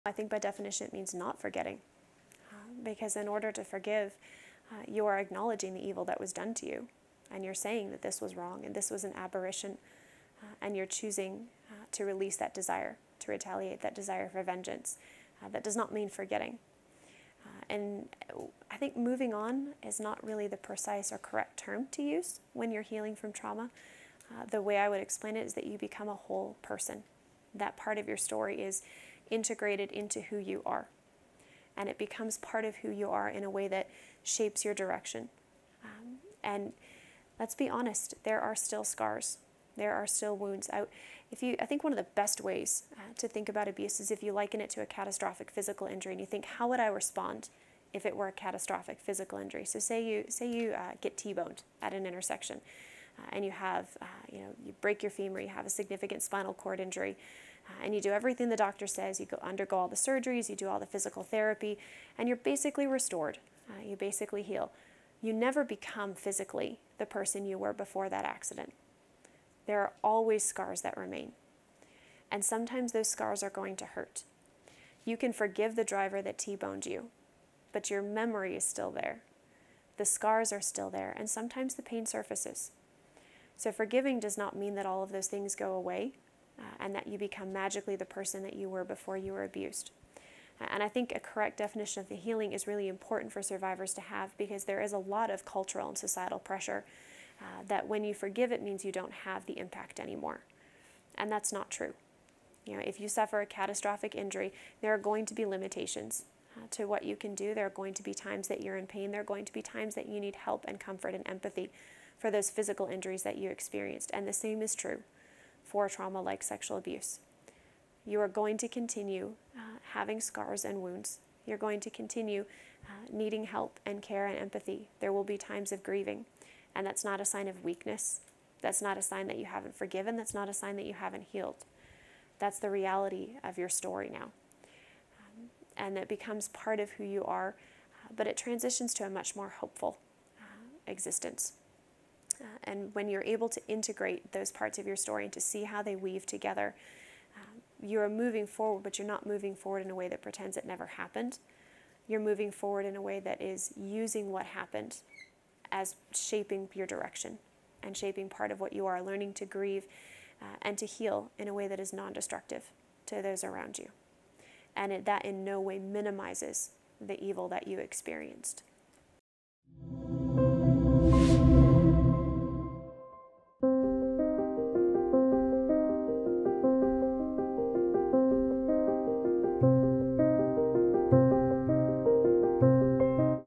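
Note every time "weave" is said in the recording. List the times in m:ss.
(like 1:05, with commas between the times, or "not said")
2:25.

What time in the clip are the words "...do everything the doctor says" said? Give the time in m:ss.
0:58.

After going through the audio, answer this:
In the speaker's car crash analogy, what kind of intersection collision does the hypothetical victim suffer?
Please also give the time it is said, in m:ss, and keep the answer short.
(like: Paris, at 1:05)
T-boned, at 0:51.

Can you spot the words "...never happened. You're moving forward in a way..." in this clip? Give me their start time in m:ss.
2:30.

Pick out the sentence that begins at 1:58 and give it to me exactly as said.
You are going to continue uh, having scars and wounds.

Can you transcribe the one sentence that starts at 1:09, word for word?
There are always scars that remain.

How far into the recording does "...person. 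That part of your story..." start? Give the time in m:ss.
0:26.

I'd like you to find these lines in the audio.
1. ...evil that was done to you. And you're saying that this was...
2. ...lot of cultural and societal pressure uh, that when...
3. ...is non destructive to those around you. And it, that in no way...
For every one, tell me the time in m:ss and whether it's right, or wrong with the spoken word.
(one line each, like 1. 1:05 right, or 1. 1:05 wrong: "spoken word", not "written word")
1. 0:05 right
2. 1:34 right
3. 2:41 right.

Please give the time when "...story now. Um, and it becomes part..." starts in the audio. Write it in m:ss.
2:13.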